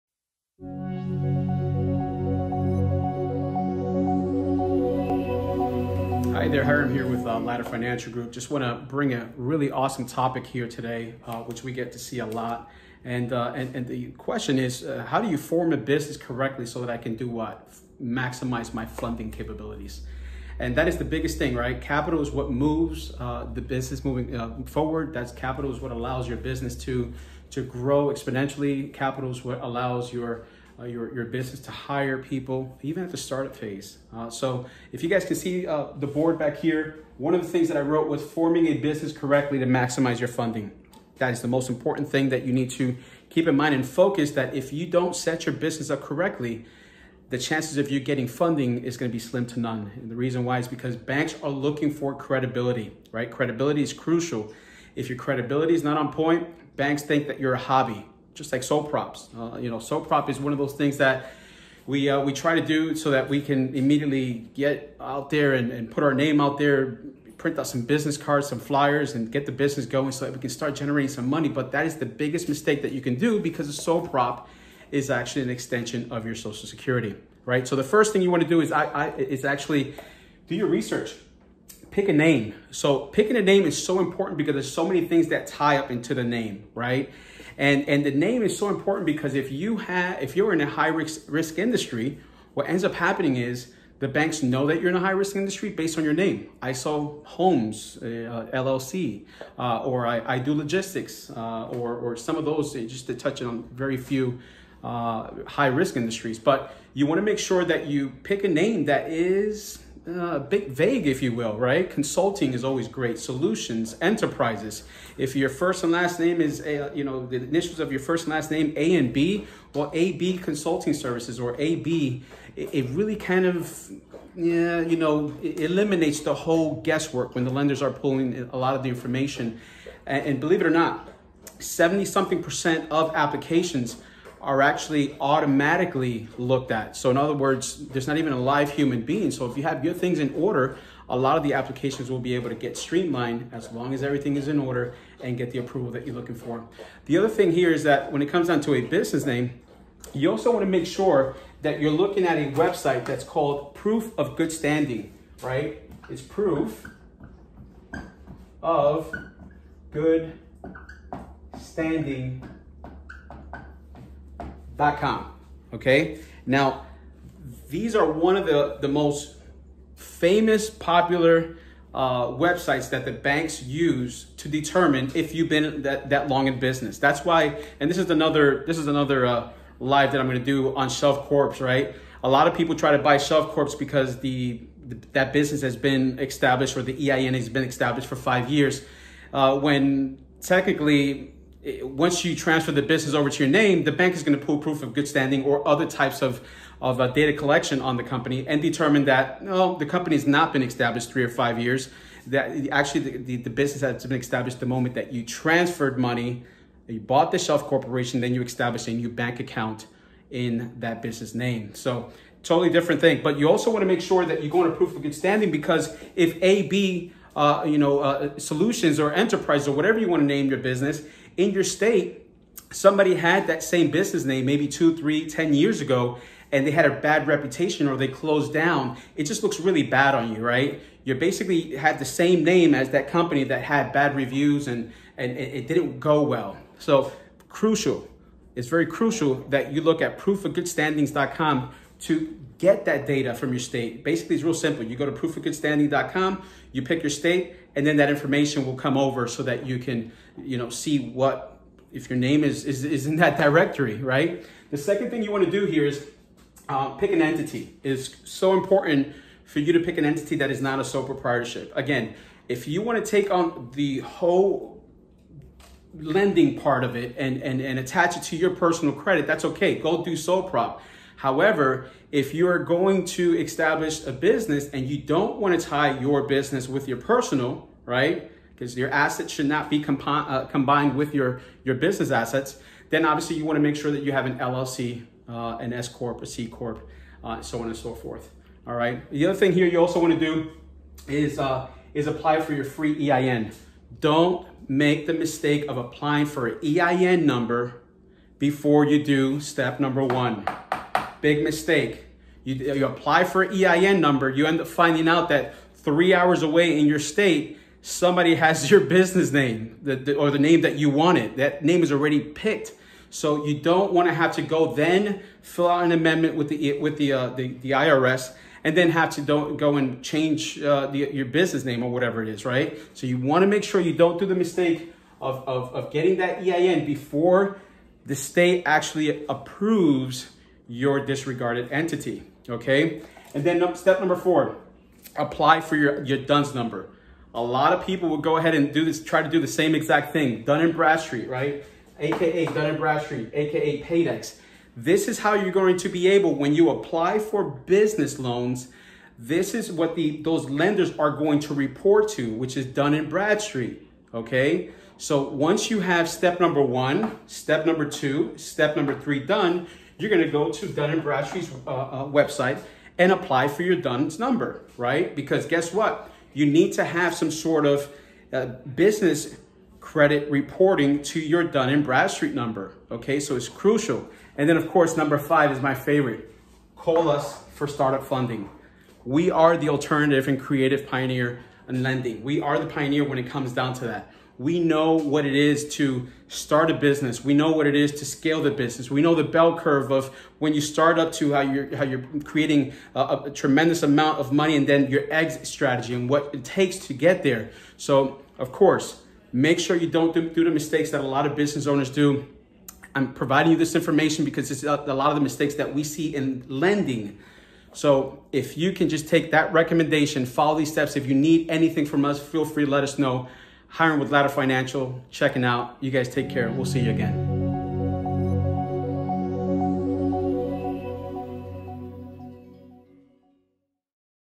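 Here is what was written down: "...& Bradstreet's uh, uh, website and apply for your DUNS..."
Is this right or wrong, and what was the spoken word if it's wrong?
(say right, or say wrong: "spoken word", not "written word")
right.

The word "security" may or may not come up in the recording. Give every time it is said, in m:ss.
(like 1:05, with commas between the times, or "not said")
1:16.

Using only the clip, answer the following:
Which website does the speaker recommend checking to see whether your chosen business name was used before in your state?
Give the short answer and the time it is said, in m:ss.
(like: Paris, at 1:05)
proofofgoodstanding.com, at 4:05.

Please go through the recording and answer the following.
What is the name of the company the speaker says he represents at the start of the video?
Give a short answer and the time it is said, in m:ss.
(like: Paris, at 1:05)
Latter Financial Group, at 0:07.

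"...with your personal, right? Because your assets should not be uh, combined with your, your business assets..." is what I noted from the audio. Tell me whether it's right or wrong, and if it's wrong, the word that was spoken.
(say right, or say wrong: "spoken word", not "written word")
right.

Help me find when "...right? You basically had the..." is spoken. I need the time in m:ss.
3:50.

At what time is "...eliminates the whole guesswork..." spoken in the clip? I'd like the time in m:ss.
2:05.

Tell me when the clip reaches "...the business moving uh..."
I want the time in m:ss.
0:23.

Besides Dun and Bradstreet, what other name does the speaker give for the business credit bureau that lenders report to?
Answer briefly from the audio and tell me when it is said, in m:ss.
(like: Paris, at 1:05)
Paydex, at 5:43.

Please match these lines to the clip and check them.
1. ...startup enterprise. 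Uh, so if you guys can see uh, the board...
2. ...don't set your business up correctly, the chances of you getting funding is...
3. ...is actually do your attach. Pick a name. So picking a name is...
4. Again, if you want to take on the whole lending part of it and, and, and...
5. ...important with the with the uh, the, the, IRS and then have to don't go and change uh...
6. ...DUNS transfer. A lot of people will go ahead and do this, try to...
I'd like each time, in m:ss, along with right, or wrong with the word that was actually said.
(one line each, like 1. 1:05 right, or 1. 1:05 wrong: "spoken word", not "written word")
1. 0:33 wrong: "phase", not "enterprise"
2. 0:44 right
3. 1:19 wrong: "research", not "attach"
4. 4:21 right
5. 5:15 wrong: "amendment", not "important"
6. 5:36 wrong: "number", not "transfer".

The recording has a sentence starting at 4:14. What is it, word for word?
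The second thing you want to do here is uh, pick an entity.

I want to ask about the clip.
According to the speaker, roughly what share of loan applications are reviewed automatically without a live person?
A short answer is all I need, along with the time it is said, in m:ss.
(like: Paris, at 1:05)
70 something percent, at 2:11.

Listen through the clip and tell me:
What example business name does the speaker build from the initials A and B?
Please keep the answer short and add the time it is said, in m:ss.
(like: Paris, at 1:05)
AB Consulting Services, at 1:59.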